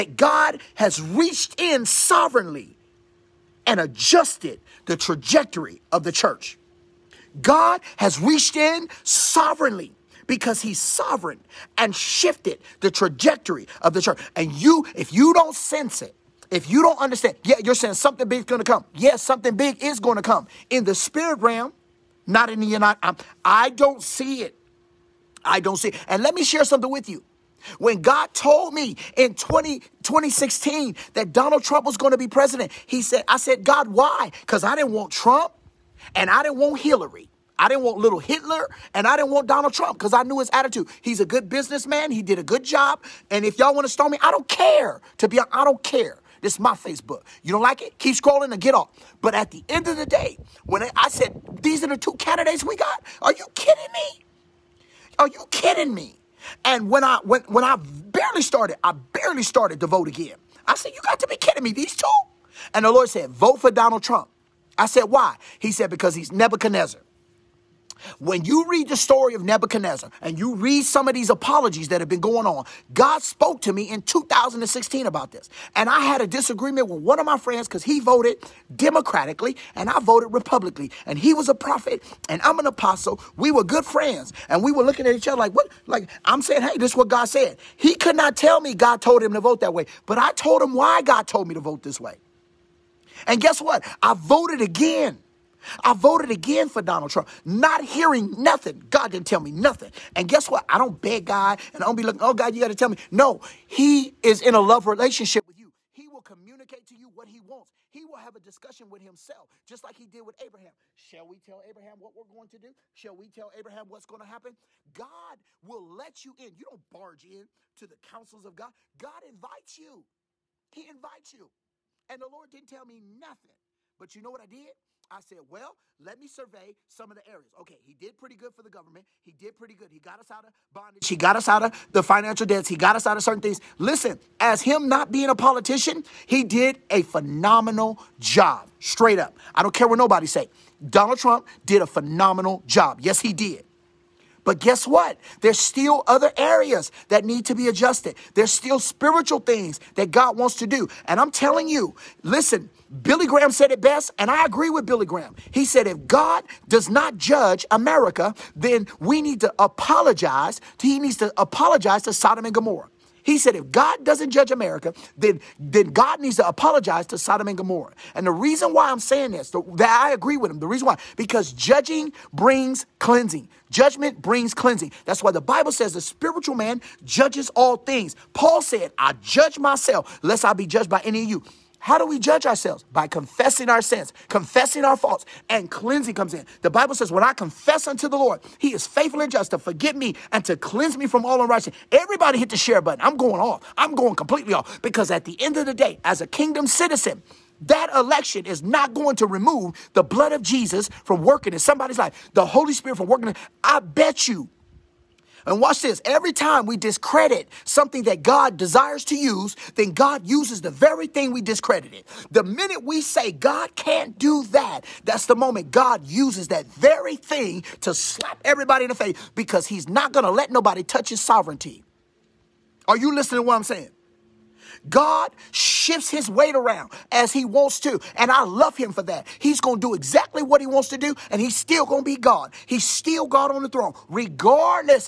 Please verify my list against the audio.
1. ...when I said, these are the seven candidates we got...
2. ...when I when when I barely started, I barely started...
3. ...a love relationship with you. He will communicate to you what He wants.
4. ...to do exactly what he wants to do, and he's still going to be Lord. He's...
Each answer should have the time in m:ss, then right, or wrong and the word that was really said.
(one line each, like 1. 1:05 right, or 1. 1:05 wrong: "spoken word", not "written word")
1. 0:50 wrong: "two", not "seven"
2. 0:56 right
3. 1:44 right
4. 3:49 wrong: "God", not "Lord".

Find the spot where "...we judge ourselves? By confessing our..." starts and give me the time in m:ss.
3:02.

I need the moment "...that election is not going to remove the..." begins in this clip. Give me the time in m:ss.
3:17.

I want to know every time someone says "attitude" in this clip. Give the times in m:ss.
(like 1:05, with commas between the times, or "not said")
0:40.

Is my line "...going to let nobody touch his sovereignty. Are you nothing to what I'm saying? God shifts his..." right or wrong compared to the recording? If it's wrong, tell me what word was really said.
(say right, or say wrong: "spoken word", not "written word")
wrong: "listening", not "nothing".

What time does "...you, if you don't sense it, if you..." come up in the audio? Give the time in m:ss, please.
0:14.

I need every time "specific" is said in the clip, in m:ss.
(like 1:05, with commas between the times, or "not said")
not said.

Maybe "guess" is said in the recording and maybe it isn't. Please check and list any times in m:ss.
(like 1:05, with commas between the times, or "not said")
1:33, 1:40, 2:24.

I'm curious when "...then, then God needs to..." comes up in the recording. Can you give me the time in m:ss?
2:45.